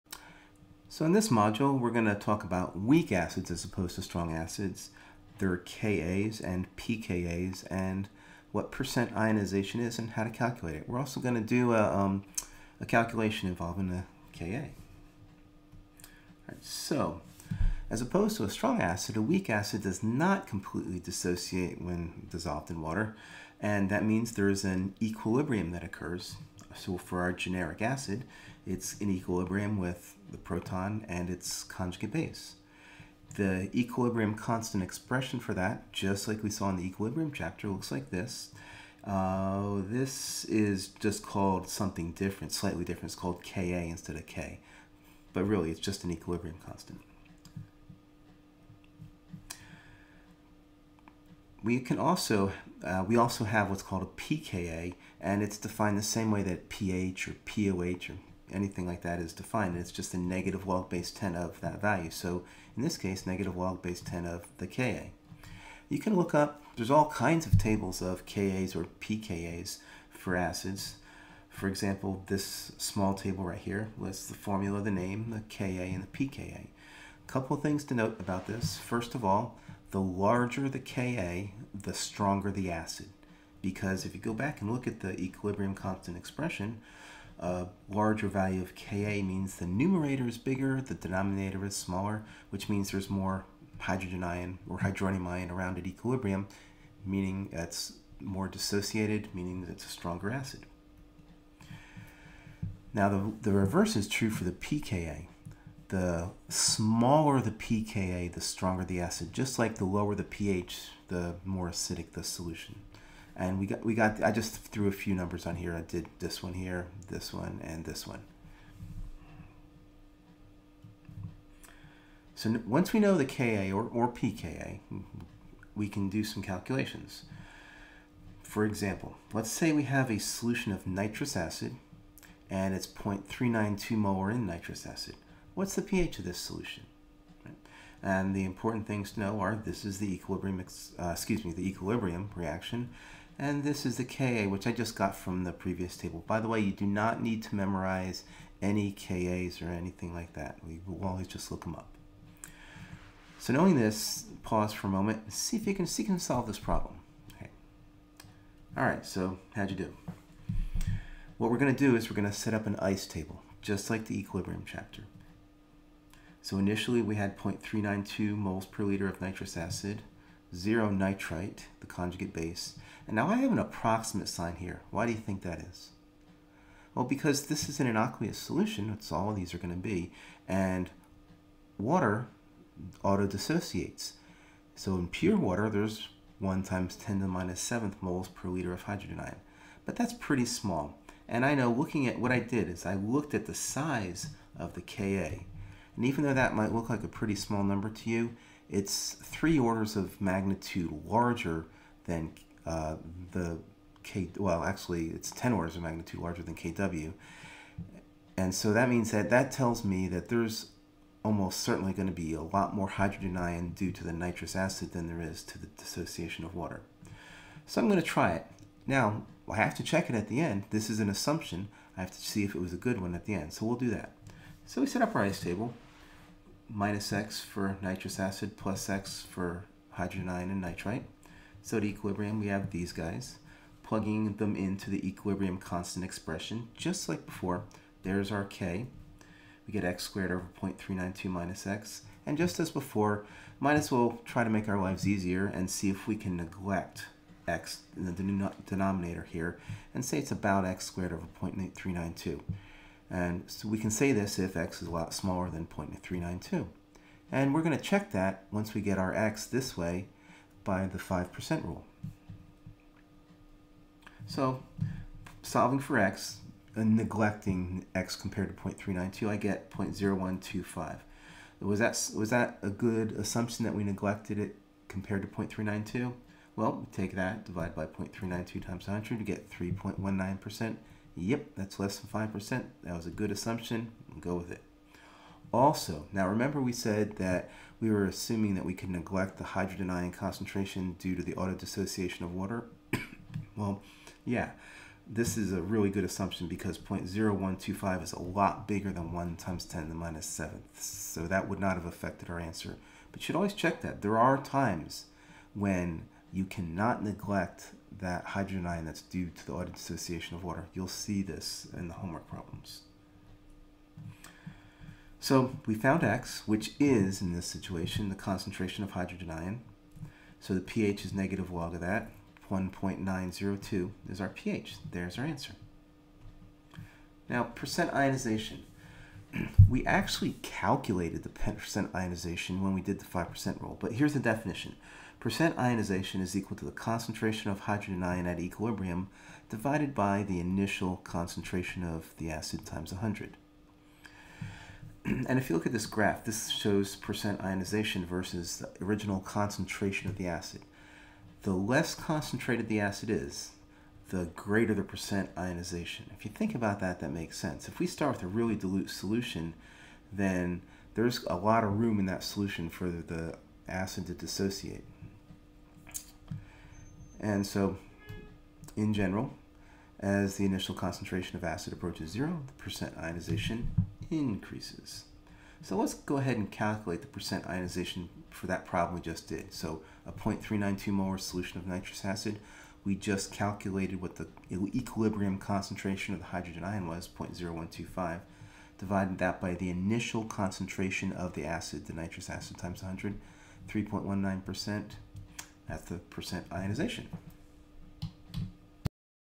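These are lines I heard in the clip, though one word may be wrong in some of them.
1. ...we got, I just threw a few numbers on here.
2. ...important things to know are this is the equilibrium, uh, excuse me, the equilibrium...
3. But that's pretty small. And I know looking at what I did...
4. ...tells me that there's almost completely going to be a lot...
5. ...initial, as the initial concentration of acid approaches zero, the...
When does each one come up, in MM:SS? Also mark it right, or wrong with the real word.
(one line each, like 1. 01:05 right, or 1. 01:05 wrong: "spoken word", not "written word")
1. 01:53 right
2. 02:18 right
3. 03:09 right
4. 03:29 wrong: "certainly", not "completely"
5. 06:08 wrong: "general", not "initial".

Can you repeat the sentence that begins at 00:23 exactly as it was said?
And that means there is an equilibrium that occurs.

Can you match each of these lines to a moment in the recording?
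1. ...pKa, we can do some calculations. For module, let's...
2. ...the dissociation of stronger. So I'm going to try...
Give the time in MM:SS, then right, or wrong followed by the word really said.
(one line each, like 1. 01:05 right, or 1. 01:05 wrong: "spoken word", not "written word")
1. 02:04 wrong: "example", not "module"
2. 03:35 wrong: "water", not "stronger".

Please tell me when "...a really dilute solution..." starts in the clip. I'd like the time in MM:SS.
05:58.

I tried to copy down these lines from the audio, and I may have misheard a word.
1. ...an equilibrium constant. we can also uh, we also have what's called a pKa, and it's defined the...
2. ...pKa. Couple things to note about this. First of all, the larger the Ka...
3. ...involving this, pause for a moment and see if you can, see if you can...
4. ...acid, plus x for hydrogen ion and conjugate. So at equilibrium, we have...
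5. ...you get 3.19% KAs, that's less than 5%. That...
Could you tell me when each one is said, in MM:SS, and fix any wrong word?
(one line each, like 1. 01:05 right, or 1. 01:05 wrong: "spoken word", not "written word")
1. 00:46 right
2. 01:16 right
3. 02:33 wrong: "knowing", not "involving"
4. 03:48 wrong: "nitrite", not "conjugate"
5. 04:39 wrong: "Yep", not "KAs".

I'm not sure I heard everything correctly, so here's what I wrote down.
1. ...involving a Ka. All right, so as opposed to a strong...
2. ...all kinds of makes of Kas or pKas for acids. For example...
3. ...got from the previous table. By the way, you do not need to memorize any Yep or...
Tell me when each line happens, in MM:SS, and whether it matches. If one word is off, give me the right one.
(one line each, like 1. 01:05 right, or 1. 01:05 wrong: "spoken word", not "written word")
1. 00:13 right
2. 01:06 wrong: "tables", not "makes"
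3. 02:24 wrong: "Kas", not "Yep".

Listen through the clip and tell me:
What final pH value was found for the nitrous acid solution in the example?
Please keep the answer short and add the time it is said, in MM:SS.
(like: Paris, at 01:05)
1.902, at 05:22.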